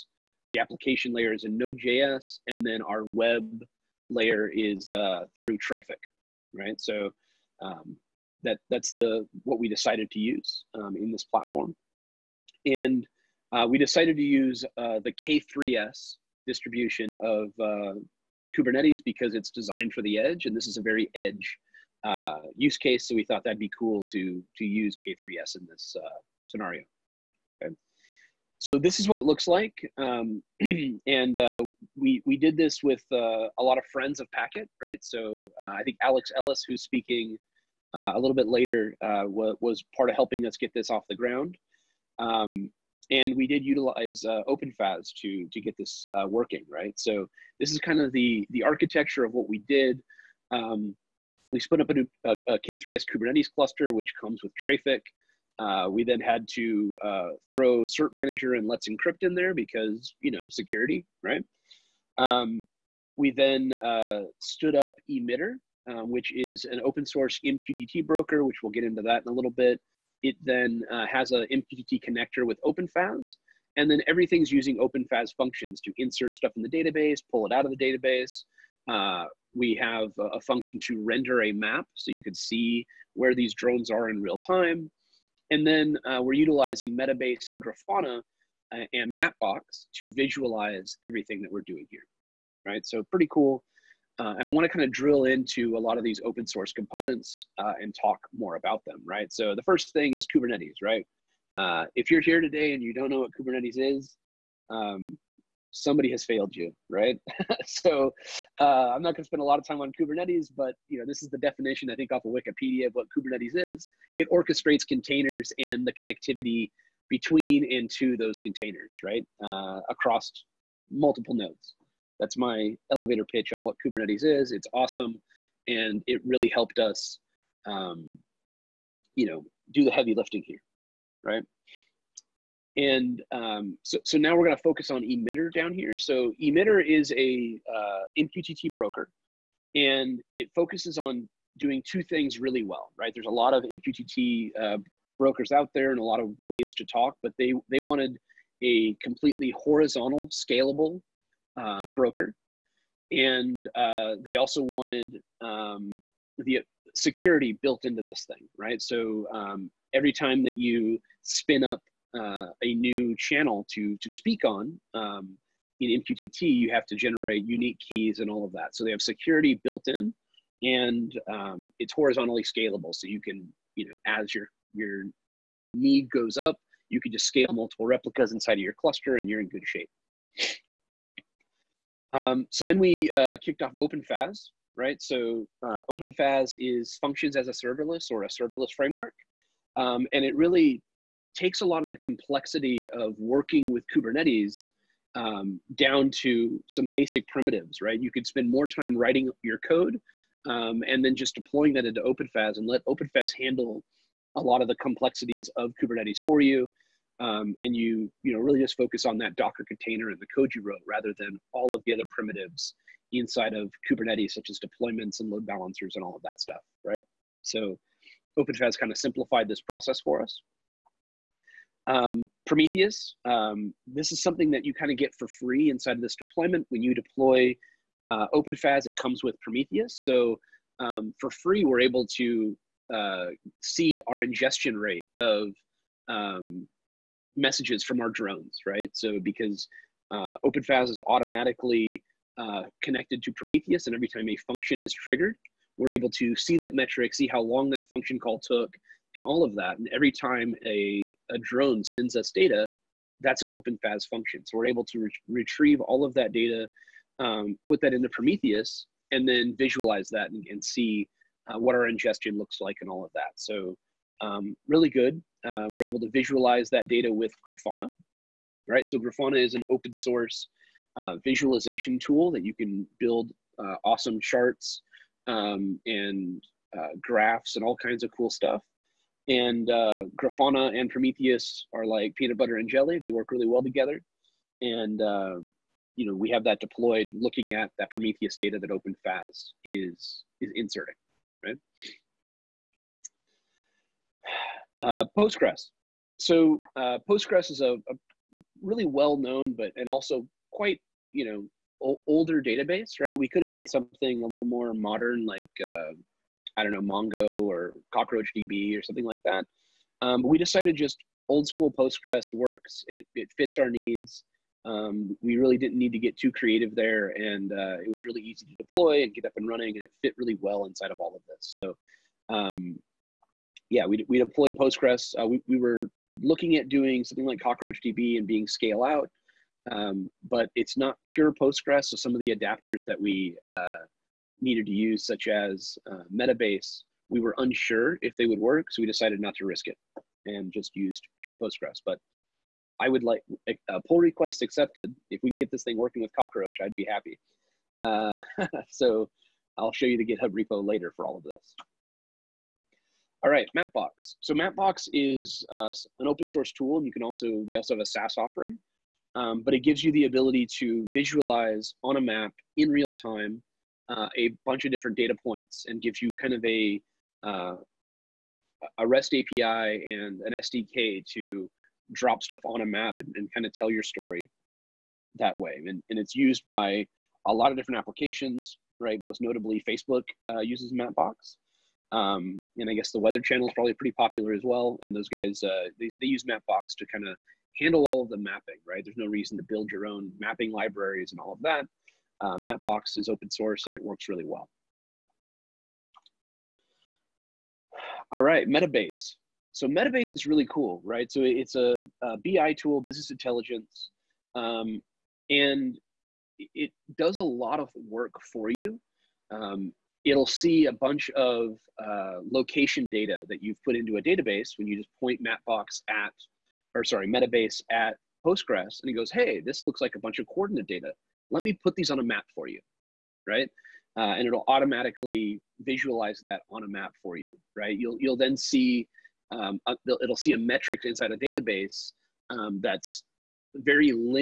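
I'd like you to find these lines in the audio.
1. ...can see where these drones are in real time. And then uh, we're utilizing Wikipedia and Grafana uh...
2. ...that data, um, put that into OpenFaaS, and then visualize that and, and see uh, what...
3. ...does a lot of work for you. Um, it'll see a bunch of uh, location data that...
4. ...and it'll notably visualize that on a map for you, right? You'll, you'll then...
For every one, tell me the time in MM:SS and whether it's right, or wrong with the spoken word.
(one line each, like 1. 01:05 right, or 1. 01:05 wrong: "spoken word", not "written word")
1. 01:22 wrong: "Metabase", not "Wikipedia"
2. 04:16 wrong: "Prometheus", not "OpenFaaS"
3. 06:46 right
4. 07:04 wrong: "automatically", not "notably".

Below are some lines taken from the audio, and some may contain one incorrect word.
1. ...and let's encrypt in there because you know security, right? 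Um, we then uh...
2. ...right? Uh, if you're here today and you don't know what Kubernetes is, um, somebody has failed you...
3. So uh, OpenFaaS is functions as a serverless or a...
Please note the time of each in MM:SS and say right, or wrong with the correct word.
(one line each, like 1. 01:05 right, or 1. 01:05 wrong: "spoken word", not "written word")
1. 00:58 right
2. 01:40 right
3. 03:05 right.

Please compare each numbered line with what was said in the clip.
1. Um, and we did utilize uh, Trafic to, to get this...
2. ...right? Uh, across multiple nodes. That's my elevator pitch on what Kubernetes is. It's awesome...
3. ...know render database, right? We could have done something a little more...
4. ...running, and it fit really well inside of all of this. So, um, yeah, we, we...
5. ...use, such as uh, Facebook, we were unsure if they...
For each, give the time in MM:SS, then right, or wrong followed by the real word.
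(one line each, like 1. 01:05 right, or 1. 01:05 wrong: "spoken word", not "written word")
1. 00:42 wrong: "OpenFAS", not "Trafic"
2. 01:59 right
3. 05:01 wrong: "older", not "render"
4. 05:19 right
5. 05:34 wrong: "Metabase", not "Facebook".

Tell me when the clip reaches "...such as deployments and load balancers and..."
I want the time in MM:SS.
03:34.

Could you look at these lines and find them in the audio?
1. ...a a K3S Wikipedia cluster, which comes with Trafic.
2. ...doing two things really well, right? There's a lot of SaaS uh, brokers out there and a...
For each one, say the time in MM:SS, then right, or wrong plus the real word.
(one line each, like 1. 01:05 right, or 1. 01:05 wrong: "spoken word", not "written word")
1. 00:51 wrong: "Kubernetes", not "Wikipedia"
2. 02:21 wrong: "MQTT", not "SaaS".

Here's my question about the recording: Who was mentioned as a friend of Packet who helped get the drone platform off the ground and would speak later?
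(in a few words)
Alex Ellis.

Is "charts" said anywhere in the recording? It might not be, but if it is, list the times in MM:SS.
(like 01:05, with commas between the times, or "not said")
04:34.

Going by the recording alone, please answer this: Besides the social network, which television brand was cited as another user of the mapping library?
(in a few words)
the Weather Channel.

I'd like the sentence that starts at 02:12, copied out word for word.
And um, so, so now we're going to focus on Emitter down here.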